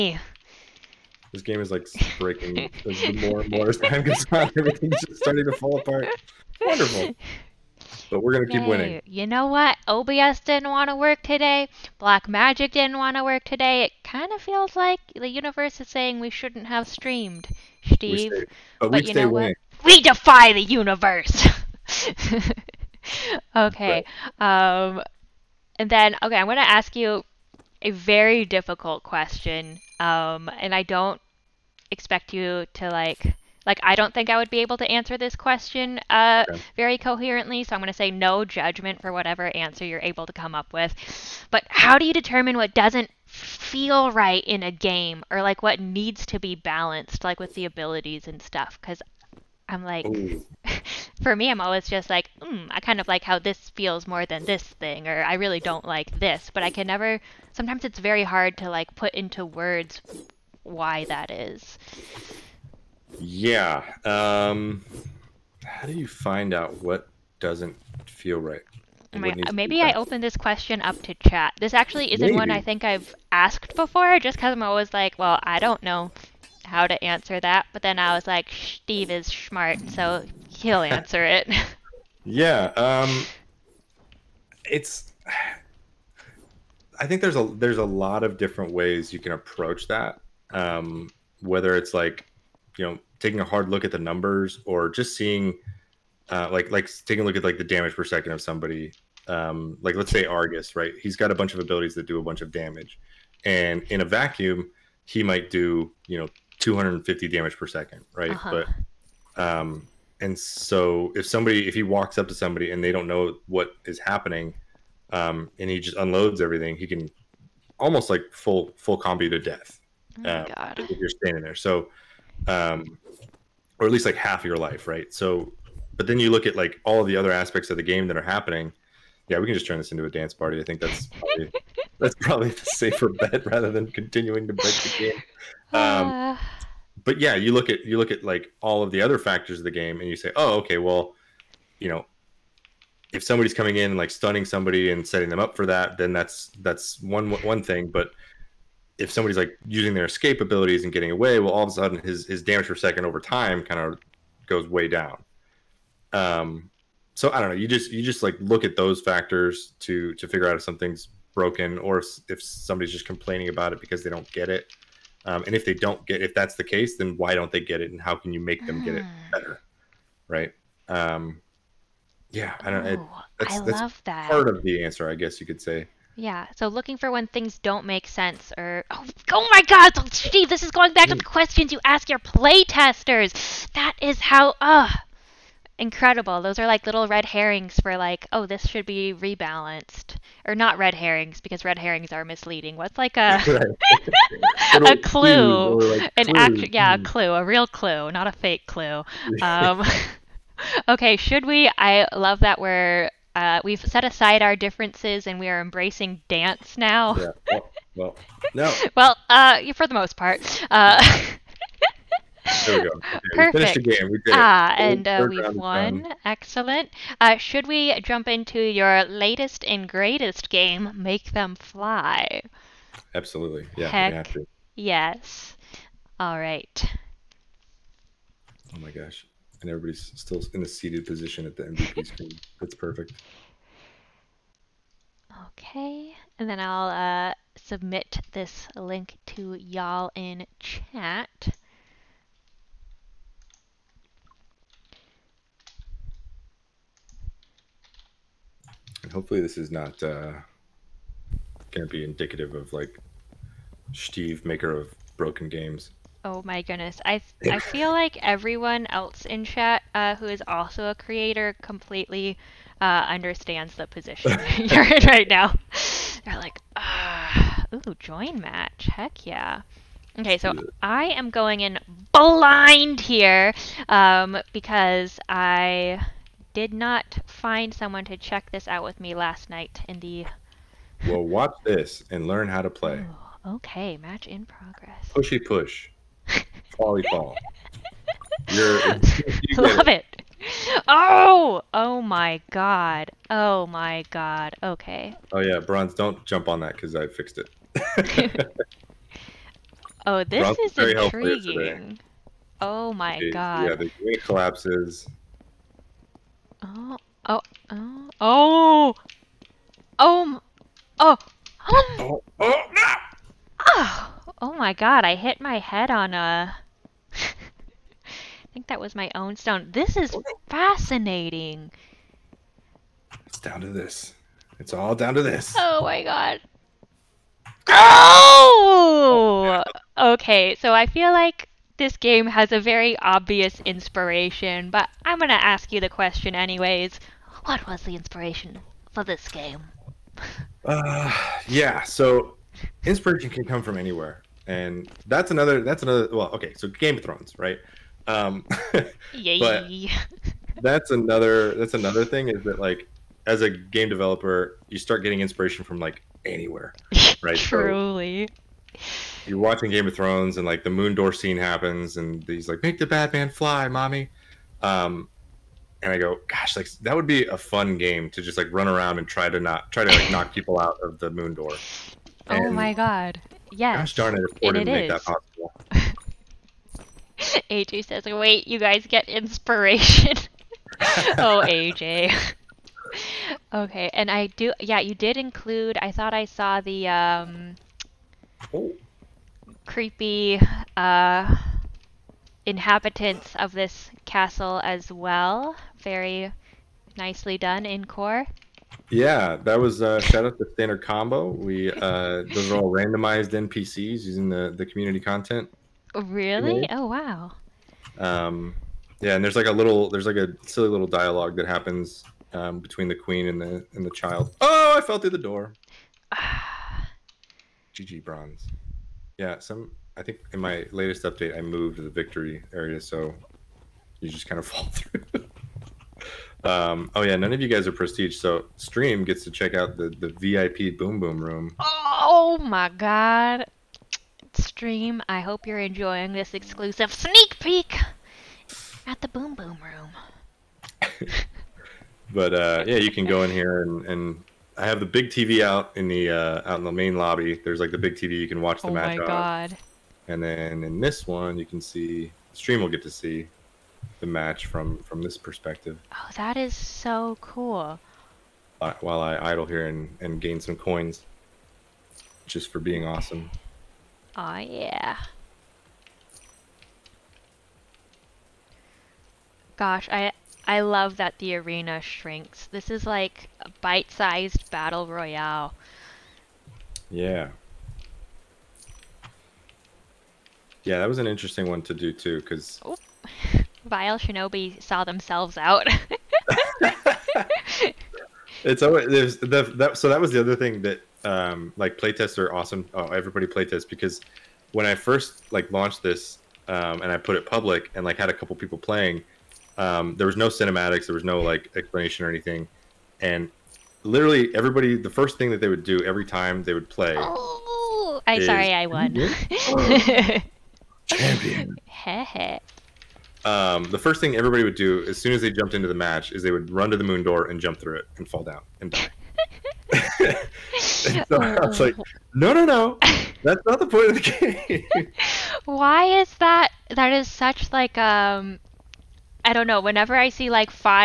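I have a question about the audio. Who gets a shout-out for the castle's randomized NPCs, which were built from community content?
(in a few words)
Standard Combo.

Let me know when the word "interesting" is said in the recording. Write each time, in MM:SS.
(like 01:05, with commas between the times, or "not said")
08:01.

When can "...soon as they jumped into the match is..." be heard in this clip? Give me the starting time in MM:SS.
08:34.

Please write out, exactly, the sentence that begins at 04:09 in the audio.
And hopefully, this is not uh, going to be indicative of like Steve, maker of broken games.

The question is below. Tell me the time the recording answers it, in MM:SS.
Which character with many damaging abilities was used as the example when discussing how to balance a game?
01:40.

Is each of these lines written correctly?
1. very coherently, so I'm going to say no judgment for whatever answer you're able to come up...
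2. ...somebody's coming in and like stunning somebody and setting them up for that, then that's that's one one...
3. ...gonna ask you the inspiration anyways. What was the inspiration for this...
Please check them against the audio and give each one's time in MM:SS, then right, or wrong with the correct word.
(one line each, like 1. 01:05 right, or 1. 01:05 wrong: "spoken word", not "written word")
1. 00:36 right
2. 02:23 right
3. 05:35 wrong: "question", not "inspiration".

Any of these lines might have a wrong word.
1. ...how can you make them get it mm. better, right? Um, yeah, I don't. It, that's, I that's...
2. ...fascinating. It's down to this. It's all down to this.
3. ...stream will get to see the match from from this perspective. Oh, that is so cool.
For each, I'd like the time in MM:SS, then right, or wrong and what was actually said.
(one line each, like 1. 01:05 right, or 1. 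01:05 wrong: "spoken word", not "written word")
1. 02:48 right
2. 05:20 right
3. 07:32 right.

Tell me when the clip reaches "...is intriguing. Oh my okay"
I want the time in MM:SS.
05:00.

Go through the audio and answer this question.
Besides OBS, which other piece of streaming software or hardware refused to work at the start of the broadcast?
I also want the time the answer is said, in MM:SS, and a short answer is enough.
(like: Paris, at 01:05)
Black Magic, at 00:11.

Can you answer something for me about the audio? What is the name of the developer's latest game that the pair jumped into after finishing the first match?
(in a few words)
Make Them Fly.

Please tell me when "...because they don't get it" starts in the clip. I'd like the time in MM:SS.
02:43.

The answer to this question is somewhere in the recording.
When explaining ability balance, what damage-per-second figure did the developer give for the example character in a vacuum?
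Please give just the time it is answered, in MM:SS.
01:46.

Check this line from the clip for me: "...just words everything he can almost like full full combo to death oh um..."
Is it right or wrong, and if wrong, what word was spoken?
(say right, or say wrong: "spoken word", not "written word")
wrong: "unloads", not "words".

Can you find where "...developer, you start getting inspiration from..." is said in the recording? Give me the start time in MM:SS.
05:53.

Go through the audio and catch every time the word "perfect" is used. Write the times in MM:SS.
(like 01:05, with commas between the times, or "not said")
03:33, 03:52.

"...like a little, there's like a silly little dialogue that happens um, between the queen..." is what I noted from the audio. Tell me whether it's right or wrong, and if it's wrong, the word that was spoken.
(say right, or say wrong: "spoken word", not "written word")
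right.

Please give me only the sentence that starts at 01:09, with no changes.
maybe I open this question up to chat.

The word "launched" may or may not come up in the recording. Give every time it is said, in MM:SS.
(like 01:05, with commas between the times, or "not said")
08:15.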